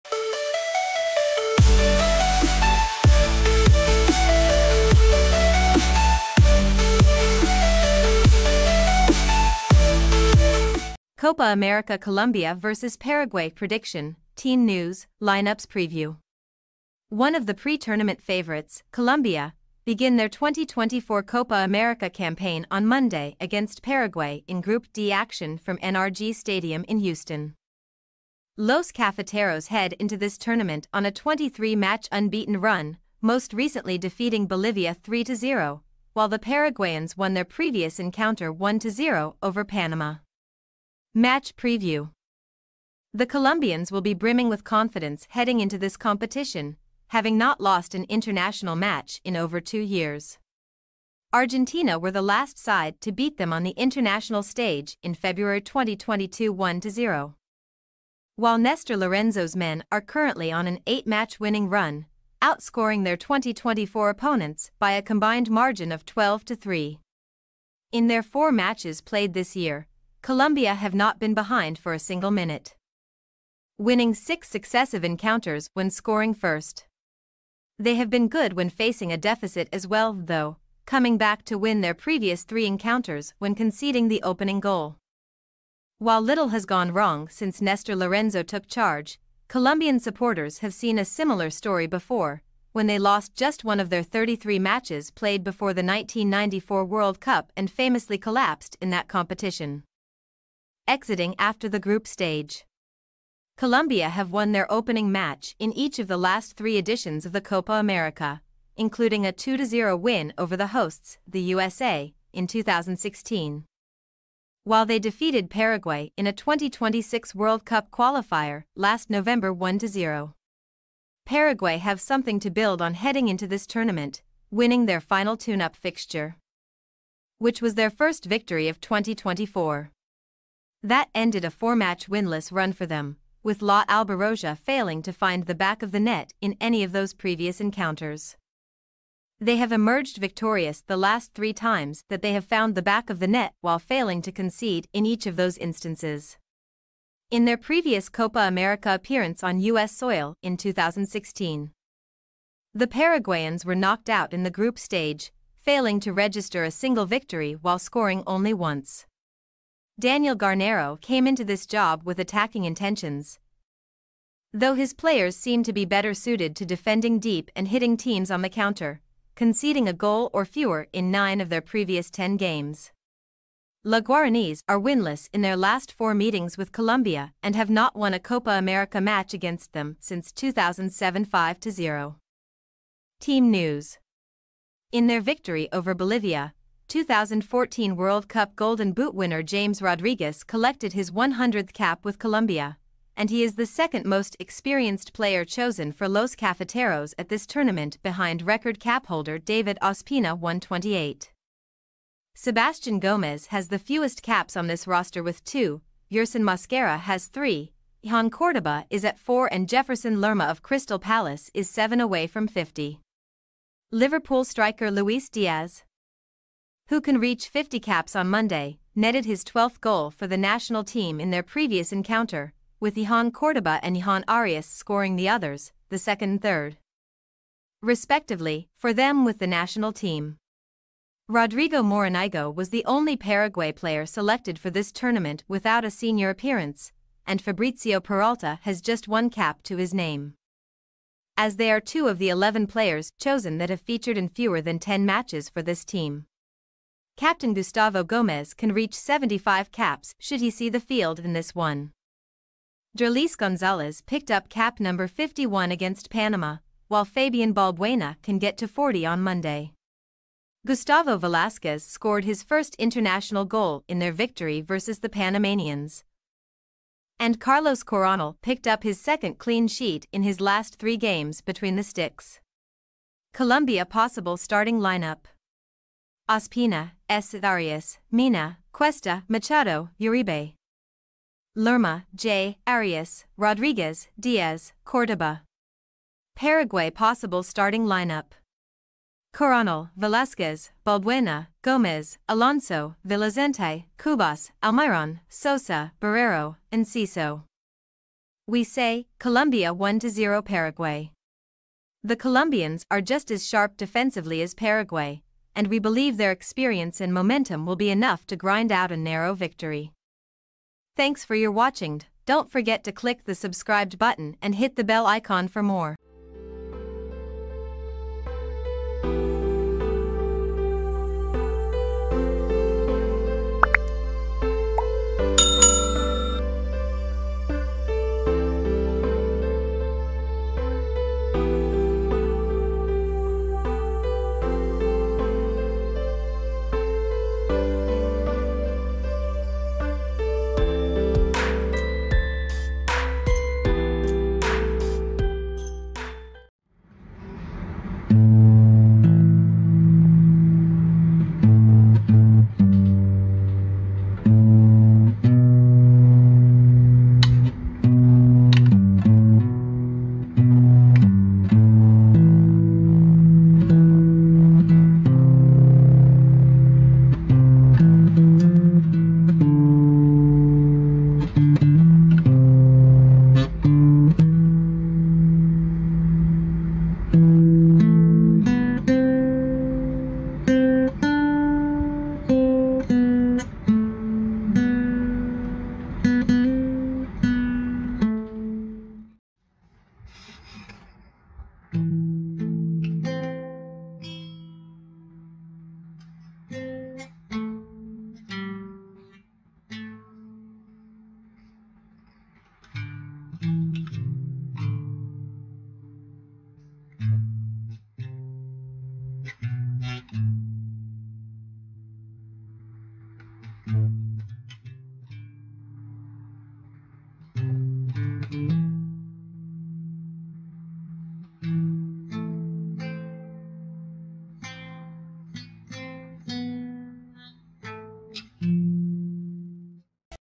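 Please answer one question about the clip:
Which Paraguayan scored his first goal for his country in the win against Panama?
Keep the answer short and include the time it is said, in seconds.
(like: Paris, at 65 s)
Gustavo Velasquez, at 260 s.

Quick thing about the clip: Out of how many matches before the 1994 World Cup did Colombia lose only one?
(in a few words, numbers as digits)
33.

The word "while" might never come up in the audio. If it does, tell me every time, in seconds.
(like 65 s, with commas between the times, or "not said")
36 s, 58 s, 85 s, 114 s, 143 s, 157 s, 256 s.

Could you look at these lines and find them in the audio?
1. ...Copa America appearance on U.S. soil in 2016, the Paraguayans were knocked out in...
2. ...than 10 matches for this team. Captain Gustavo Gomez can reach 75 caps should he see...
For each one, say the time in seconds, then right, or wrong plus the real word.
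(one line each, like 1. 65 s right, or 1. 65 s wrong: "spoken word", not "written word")
1. 148 s right
2. 244 s right.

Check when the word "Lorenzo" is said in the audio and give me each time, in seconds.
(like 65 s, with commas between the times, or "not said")
58 s, 87 s.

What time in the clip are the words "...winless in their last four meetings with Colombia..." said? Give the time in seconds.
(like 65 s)
174 s.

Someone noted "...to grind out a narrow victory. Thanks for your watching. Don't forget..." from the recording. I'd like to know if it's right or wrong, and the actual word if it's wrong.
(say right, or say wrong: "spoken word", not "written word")
right.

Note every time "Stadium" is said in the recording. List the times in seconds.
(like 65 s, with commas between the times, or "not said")
26 s.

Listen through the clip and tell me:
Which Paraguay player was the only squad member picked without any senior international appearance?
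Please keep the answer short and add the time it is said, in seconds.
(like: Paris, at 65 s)
Rodrigo Morinigo, at 231 s.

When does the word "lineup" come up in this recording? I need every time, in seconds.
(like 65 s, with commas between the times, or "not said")
15 s, 274 s, 287 s.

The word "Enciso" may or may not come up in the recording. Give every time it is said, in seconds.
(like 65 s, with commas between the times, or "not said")
296 s.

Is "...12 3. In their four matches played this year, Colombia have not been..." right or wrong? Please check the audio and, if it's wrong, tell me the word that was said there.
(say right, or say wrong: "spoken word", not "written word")
right.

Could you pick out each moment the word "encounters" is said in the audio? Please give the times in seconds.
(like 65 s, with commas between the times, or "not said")
37 s, 75 s, 82 s, 137 s, 221 s.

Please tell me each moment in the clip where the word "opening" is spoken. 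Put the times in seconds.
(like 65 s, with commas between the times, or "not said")
84 s, 104 s.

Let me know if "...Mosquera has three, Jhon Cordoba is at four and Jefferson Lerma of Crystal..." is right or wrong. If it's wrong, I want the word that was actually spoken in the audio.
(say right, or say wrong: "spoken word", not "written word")
right.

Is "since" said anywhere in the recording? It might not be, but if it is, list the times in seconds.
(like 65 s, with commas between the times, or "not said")
87 s, 179 s.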